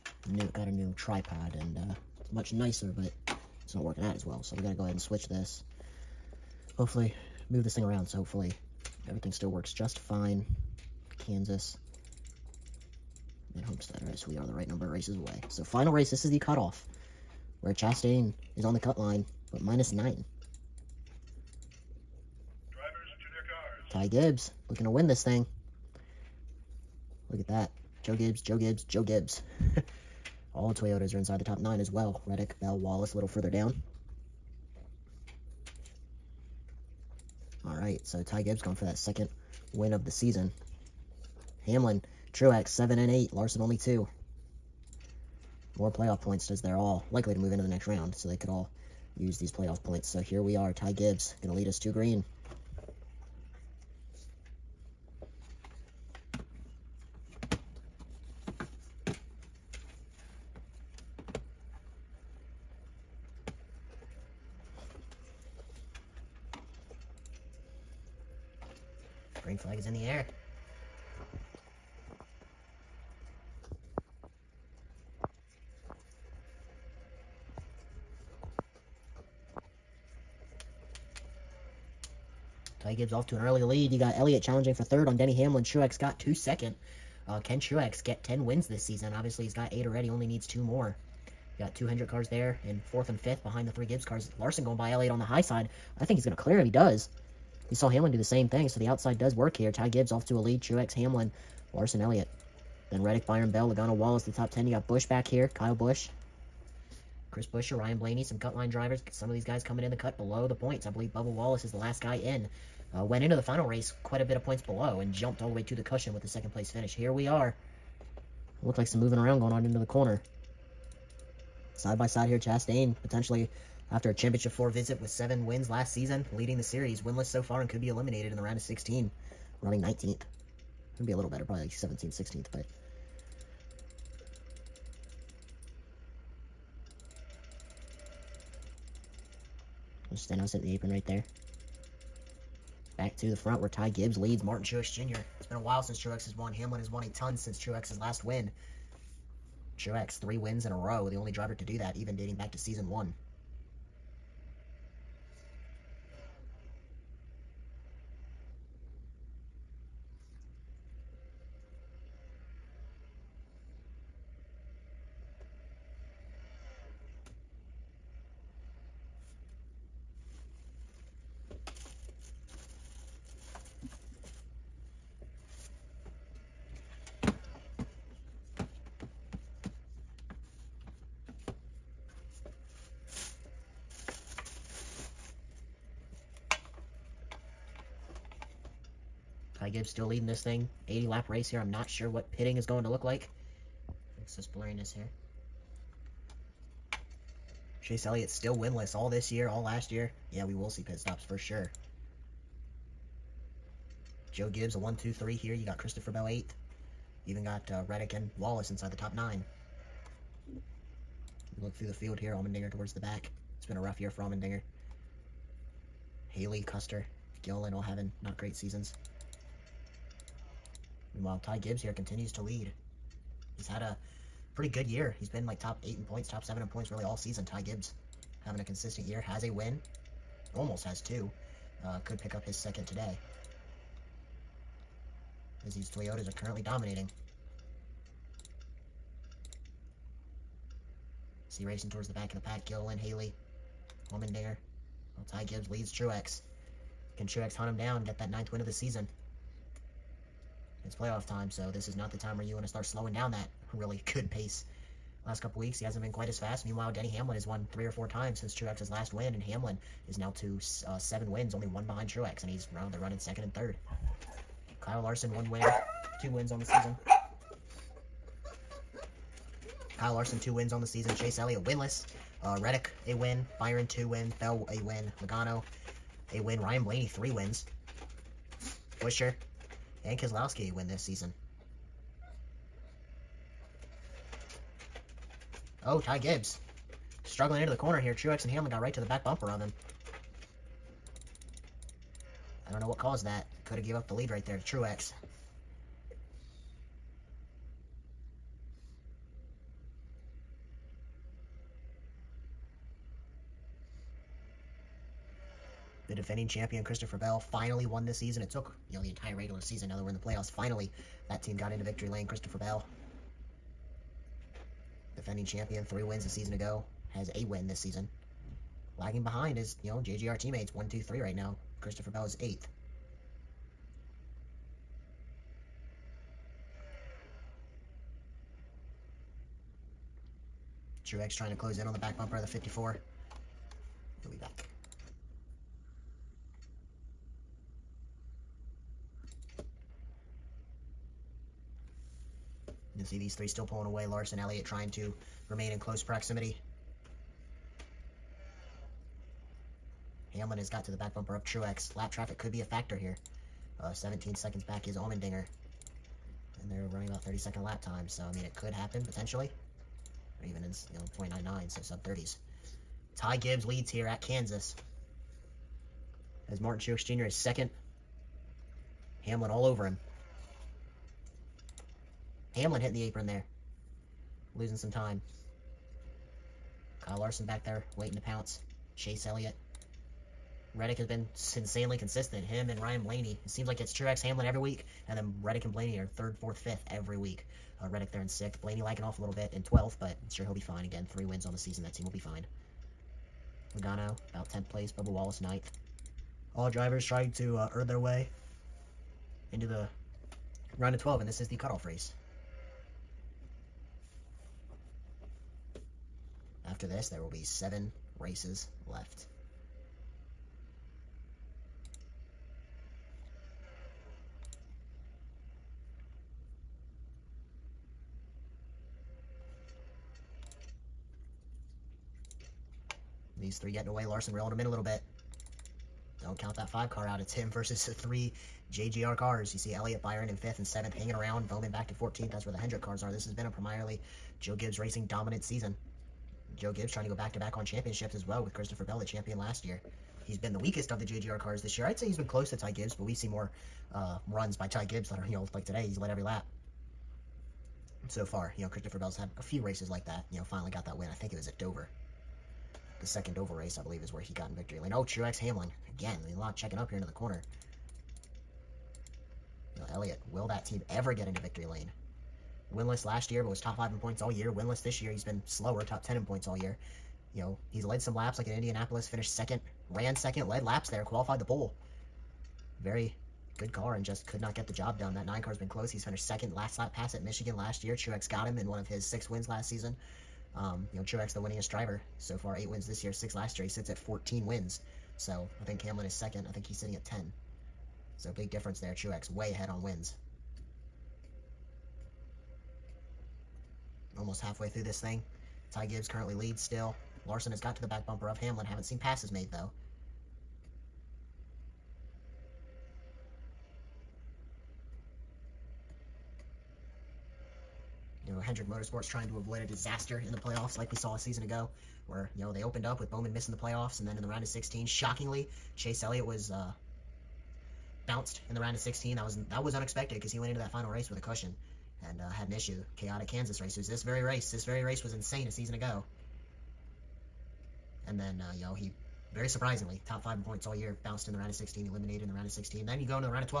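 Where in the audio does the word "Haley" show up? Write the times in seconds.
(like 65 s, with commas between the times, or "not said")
216 s, 242 s.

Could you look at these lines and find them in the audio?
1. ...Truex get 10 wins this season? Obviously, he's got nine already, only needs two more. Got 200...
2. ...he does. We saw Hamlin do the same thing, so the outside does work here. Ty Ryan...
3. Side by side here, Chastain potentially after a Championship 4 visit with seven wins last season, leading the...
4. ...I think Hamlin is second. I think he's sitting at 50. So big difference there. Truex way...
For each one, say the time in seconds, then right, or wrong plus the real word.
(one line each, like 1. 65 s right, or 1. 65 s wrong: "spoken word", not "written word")
1. 87 s wrong: "eight", not "nine"
2. 96 s wrong: "Gibbs", not "Ryan"
3. 121 s right
4. 485 s wrong: "10", not "50".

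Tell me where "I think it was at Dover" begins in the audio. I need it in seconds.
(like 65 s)
451 s.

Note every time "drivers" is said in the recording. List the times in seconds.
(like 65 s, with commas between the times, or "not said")
108 s, 151 s, 396 s, 481 s.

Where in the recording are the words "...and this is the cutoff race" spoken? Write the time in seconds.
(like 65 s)
401 s.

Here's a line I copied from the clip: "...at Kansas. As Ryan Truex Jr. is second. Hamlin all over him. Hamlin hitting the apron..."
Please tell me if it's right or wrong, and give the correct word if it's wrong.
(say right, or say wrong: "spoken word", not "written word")
wrong: "Martin", not "Ryan".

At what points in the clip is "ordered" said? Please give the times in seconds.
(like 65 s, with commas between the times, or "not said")
not said.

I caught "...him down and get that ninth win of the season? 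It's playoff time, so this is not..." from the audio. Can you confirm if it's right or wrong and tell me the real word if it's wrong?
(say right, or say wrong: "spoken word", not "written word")
right.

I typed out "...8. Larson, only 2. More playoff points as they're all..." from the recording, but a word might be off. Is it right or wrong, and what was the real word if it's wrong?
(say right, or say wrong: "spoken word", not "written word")
right.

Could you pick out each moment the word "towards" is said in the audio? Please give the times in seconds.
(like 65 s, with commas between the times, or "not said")
212 s, 241 s.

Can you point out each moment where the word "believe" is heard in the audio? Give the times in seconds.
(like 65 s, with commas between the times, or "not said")
110 s, 453 s.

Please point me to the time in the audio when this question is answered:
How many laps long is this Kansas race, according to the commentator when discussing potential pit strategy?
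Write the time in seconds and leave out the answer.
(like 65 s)
190 s.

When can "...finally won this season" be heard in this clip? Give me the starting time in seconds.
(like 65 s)
307 s.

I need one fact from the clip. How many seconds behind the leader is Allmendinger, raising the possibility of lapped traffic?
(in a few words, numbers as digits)
17.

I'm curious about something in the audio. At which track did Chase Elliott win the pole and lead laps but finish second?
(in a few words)
Indianapolis.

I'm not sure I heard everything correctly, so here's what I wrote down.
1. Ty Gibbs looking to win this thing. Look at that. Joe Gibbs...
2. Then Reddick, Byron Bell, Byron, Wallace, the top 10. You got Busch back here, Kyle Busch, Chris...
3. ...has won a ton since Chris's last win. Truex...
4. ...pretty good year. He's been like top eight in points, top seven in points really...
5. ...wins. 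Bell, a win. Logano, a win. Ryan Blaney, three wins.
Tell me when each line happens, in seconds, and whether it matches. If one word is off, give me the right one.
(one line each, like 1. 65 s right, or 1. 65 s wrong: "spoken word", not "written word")
1. 23 s right
2. 102 s wrong: "Logano", not "Byron"
3. 146 s wrong: "Truex", not "Chris"
4. 224 s right
5. 274 s right.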